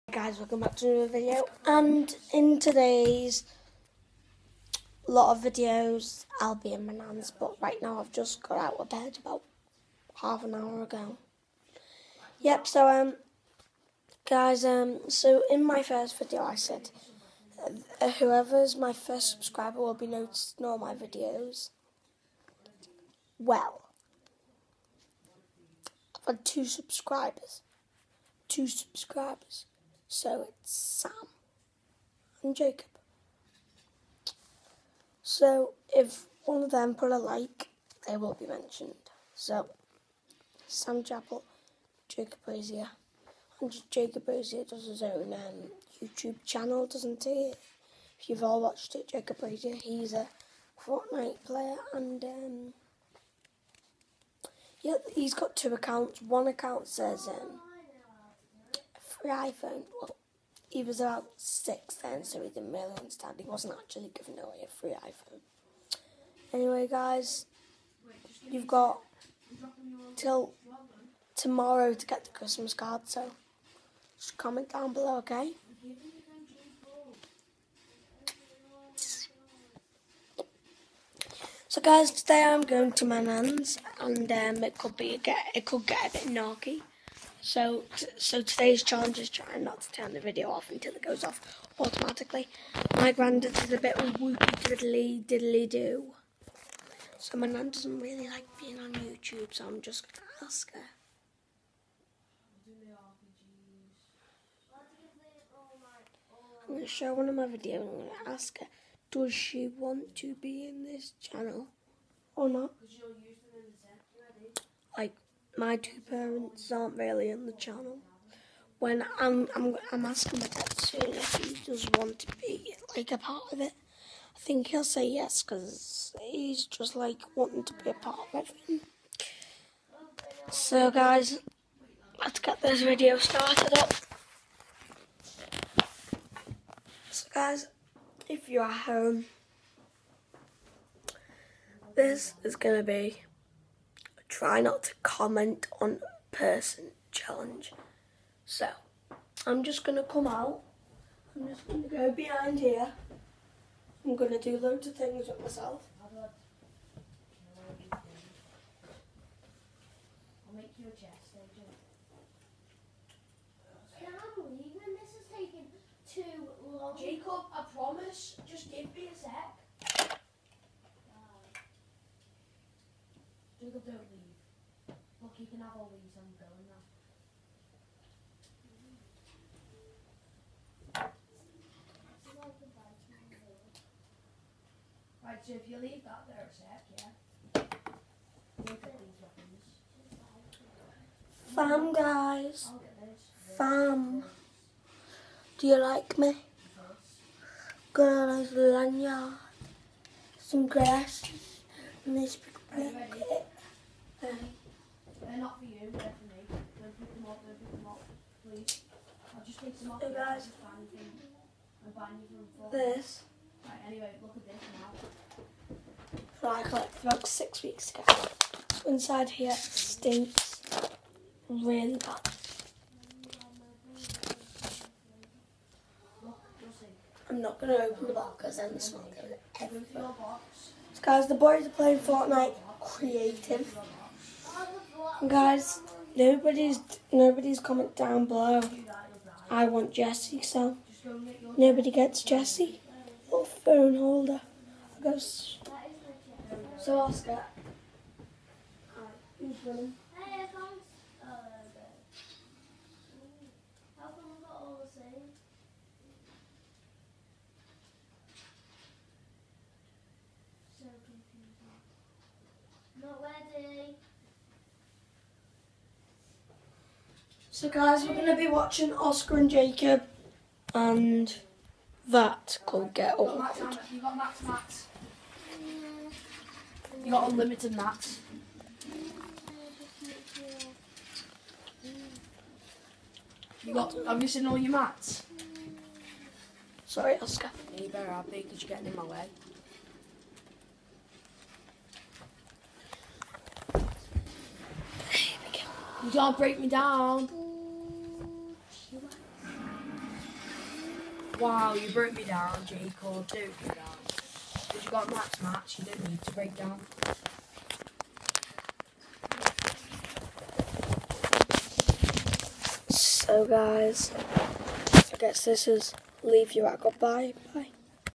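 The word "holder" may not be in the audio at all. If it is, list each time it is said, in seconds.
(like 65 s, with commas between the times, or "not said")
243 s.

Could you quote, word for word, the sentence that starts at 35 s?
So if one of them put a like, they will be mentioned.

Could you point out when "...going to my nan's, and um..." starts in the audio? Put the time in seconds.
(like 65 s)
82 s.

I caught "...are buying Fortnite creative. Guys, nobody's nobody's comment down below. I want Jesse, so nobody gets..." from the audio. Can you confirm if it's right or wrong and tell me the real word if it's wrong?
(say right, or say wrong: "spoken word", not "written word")
wrong: "playing", not "buying".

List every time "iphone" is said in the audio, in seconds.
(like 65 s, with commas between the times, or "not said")
59 s, 65 s.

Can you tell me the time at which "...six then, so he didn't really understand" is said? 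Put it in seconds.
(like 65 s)
61 s.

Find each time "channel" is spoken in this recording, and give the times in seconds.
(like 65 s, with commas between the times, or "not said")
46 s, 111 s, 117 s.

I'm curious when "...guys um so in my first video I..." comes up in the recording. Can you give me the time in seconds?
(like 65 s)
14 s.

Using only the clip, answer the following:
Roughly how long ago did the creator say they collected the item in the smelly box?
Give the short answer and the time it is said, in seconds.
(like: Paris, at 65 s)
6 weeks, at 217 s.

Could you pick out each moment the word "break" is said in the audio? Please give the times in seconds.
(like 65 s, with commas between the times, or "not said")
296 s, 306 s.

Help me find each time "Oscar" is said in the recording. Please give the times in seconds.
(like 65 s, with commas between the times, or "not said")
246 s, 268 s, 287 s.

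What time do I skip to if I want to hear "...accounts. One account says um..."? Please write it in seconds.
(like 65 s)
55 s.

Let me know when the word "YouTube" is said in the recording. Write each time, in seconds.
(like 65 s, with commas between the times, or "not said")
46 s, 98 s.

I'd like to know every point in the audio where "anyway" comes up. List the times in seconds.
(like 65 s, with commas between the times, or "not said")
66 s, 213 s.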